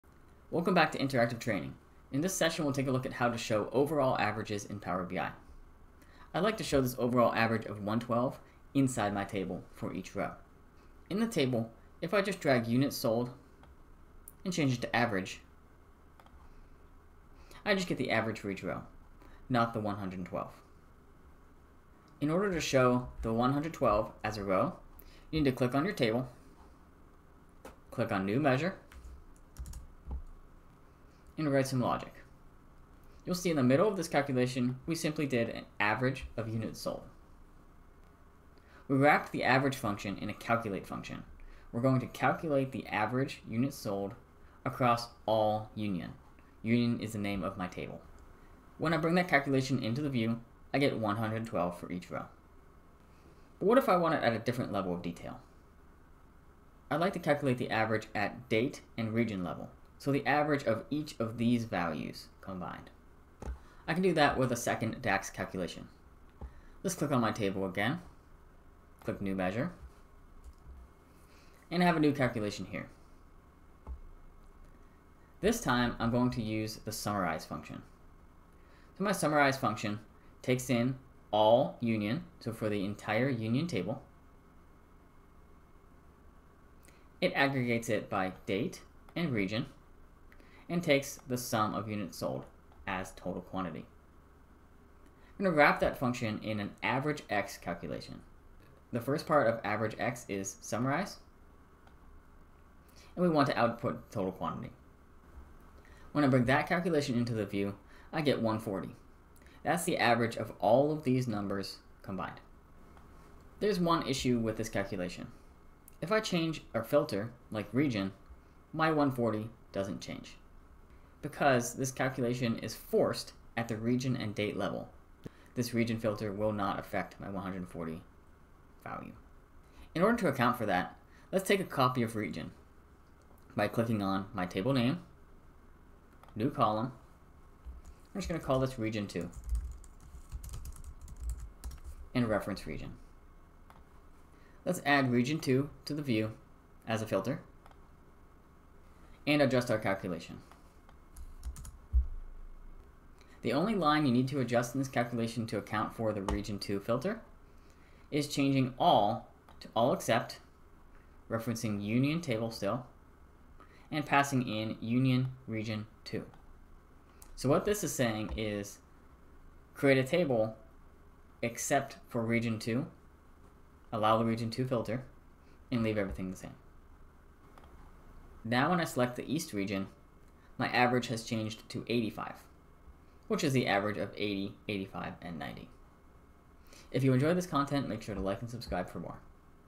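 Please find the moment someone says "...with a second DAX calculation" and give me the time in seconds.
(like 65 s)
64 s.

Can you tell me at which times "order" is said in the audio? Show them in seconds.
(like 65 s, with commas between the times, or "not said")
22 s, 130 s.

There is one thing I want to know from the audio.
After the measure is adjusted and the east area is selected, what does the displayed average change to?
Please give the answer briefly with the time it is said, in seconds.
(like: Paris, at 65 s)
85, at 180 s.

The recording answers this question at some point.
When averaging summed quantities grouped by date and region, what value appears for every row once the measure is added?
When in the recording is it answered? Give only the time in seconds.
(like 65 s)
108 s.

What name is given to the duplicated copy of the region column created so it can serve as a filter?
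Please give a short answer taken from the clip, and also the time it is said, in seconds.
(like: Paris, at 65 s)
region 2, at 138 s.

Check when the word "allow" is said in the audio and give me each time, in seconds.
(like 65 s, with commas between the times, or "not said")
173 s.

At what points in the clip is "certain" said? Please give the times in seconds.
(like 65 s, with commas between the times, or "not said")
not said.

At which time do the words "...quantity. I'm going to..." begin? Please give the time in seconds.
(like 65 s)
93 s.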